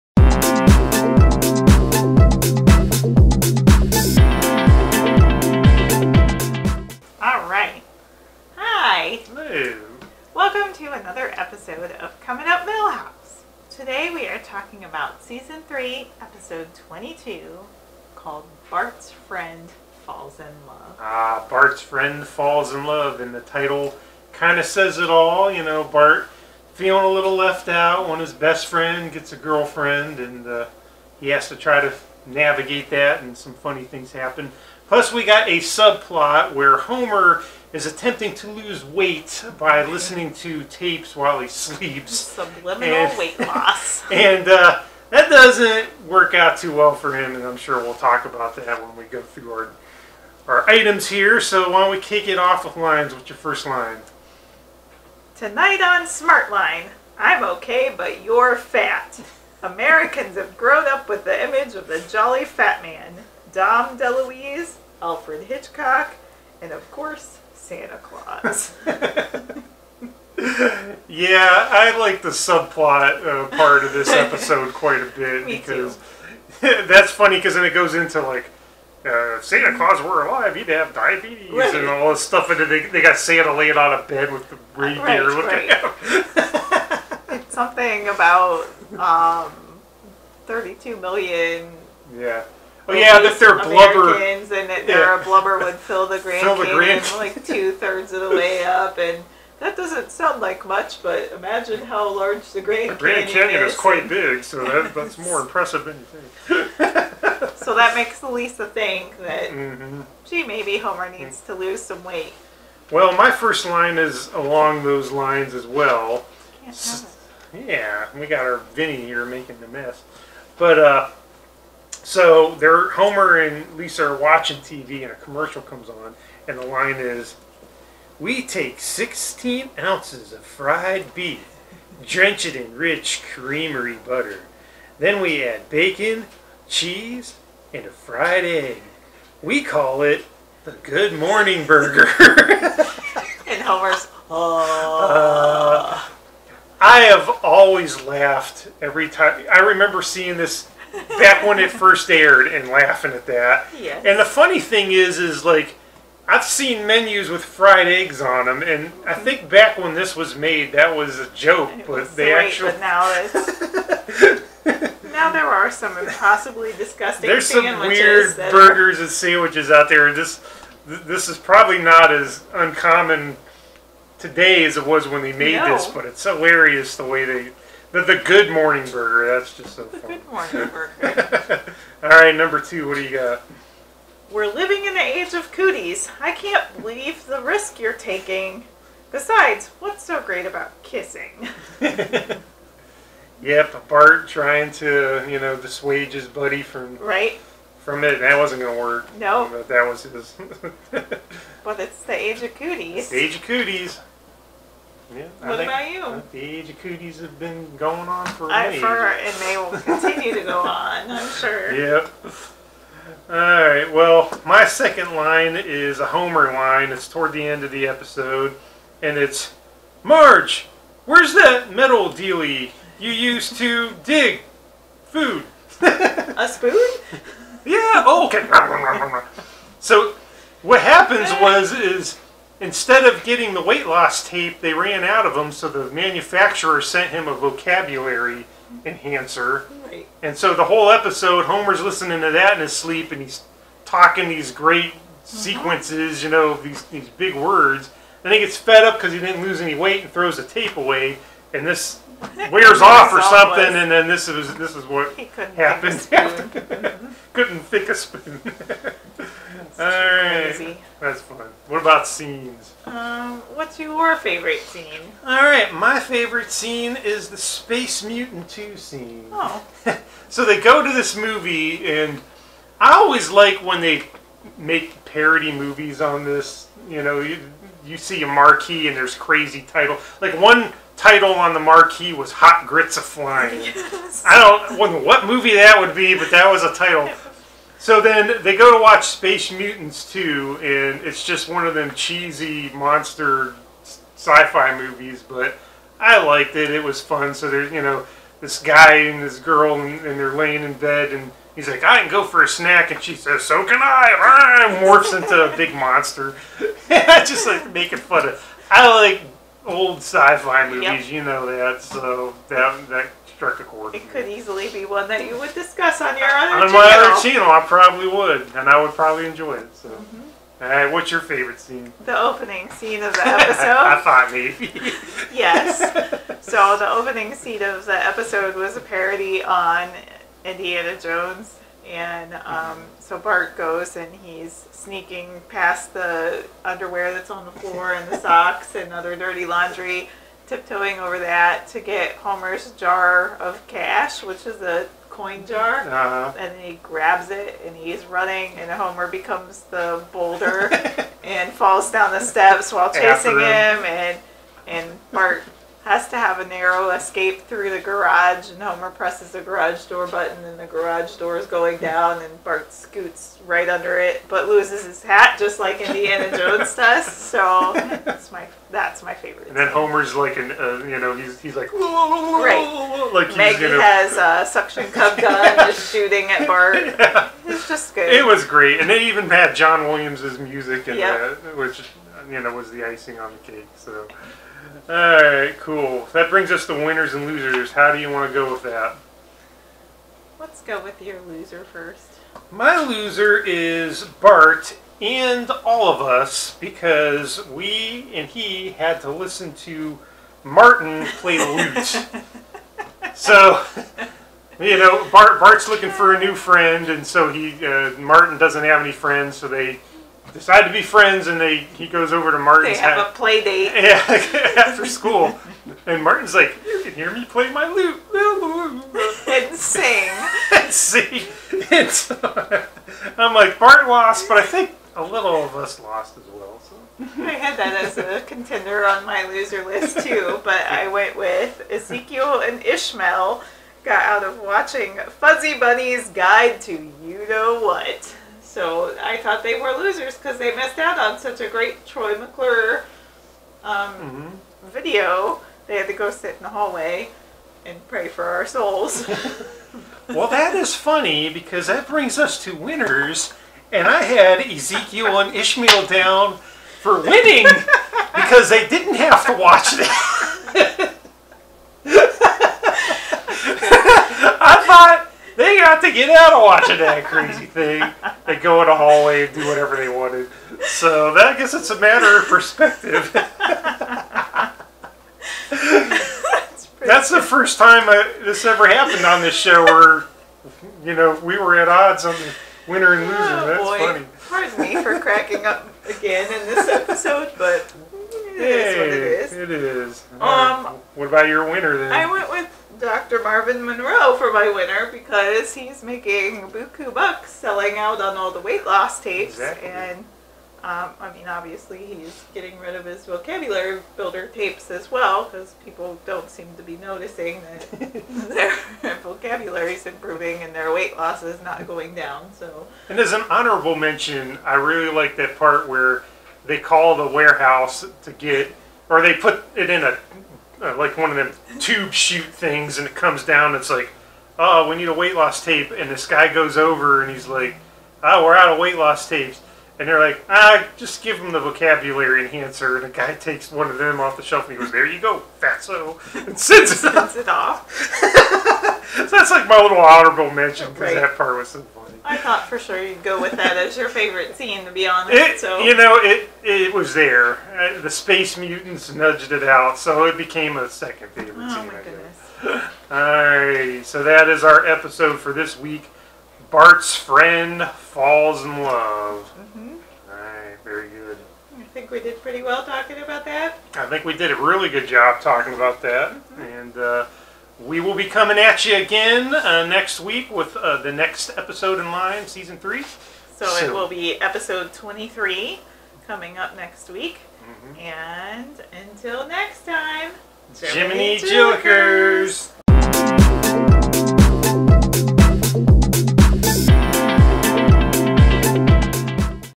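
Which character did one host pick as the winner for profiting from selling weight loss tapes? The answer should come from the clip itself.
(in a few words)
Dr. Marvin Monroe.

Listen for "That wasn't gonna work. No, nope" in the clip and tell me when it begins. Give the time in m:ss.
3:18.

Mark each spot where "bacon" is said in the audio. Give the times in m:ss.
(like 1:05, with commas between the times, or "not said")
2:15.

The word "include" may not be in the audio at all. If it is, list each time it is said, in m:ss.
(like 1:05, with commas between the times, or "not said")
not said.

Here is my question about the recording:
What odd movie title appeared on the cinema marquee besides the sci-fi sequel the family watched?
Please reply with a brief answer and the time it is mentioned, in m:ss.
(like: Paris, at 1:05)
Hot Grits of Flying, at 4:42.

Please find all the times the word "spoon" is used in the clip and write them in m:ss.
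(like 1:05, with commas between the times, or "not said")
3:46, 4:17.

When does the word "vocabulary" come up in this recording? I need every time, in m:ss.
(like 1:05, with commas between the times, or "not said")
3:57, 8:23, 8:28, 8:51.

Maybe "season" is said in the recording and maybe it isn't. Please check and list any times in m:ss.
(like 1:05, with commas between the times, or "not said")
0:15, 9:32.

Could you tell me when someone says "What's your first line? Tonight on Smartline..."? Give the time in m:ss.
0:53.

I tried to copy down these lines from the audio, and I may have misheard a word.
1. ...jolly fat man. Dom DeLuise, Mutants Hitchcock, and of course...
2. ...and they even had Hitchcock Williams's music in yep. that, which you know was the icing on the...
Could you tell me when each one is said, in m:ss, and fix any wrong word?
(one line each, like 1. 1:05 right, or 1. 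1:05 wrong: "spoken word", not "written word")
1. 1:02 wrong: "Alfred", not "Mutants"
2. 6:18 wrong: "John", not "Hitchcock".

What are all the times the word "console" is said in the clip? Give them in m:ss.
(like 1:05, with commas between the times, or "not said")
not said.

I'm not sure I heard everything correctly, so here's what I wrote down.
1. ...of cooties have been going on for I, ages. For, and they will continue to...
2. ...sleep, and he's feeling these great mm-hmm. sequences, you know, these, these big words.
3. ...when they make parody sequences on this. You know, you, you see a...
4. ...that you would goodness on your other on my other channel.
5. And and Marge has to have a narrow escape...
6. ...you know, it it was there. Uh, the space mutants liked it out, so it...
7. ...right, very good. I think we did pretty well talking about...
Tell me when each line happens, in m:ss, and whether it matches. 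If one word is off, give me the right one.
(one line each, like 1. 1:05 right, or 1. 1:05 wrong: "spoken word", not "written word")
1. 3:26 right
2. 4:02 wrong: "talking", not "feeling"
3. 4:33 wrong: "movies", not "sequences"
4. 5:15 wrong: "discuss", not "goodness"
5. 5:53 wrong: "Bart", not "Marge"
6. 9:05 wrong: "nudged", not "liked"
7. 9:20 right.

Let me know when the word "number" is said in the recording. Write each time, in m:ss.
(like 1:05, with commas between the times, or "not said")
3:02.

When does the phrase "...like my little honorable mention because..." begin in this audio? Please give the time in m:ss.
8:59.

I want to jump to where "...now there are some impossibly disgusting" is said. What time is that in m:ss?
2:45.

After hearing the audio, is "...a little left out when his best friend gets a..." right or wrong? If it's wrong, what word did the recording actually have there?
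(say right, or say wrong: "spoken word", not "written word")
right.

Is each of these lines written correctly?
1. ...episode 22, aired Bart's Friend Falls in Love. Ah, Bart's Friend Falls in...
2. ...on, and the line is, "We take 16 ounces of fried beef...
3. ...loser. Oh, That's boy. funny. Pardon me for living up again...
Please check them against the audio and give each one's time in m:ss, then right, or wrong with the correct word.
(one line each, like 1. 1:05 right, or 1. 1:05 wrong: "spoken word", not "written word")
1. 0:16 wrong: "called", not "aired"
2. 2:05 right
3. 8:03 wrong: "cracking", not "living".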